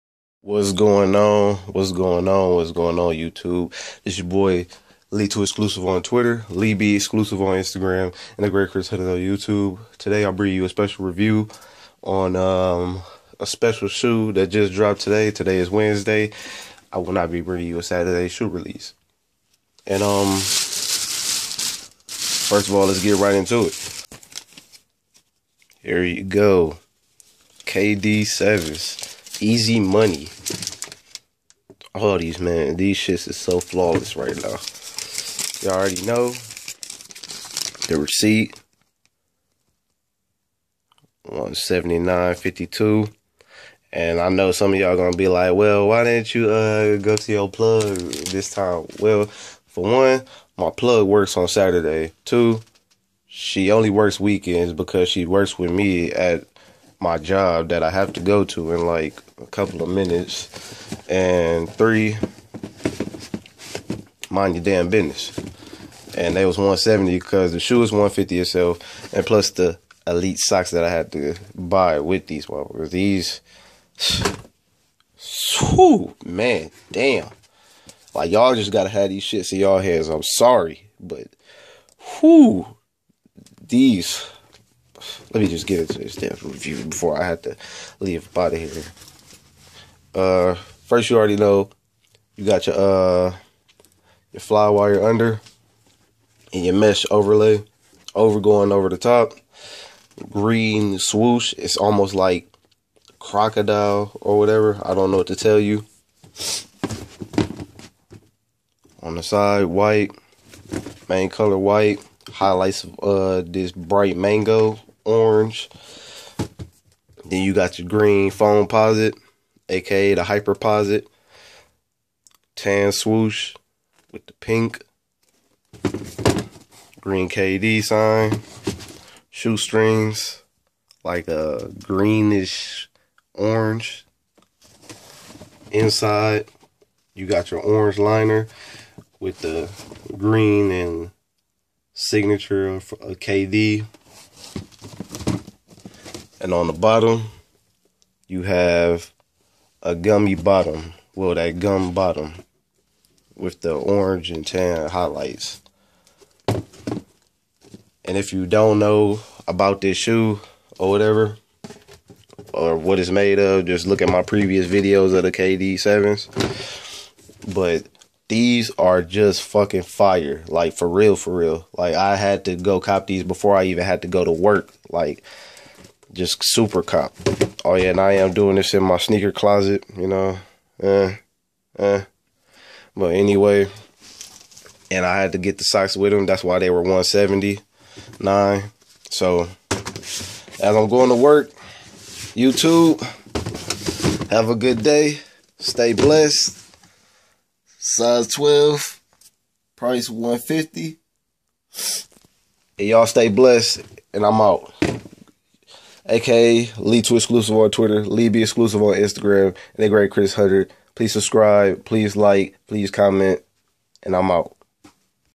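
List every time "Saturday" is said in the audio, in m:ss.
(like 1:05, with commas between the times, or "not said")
0:17, 0:51.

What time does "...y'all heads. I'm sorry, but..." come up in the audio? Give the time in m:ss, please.
1:19.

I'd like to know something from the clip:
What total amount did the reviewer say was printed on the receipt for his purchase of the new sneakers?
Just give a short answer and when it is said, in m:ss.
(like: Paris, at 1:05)
$179.52, at 0:41.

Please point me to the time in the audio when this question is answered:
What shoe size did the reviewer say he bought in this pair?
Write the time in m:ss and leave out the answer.
3:17.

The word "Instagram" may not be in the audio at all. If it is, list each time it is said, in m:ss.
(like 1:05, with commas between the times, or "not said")
0:07, 3:28.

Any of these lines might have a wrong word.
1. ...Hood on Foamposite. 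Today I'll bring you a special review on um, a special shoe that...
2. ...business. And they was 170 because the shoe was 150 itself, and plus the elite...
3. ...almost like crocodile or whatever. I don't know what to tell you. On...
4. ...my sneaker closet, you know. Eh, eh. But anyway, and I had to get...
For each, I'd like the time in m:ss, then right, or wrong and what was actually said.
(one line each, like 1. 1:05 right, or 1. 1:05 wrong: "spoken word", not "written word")
1. 0:08 wrong: "YouTube", not "Foamposite"
2. 1:04 right
3. 1:41 right
4. 2:58 right.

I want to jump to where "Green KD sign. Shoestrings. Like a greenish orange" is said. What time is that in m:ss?
2:07.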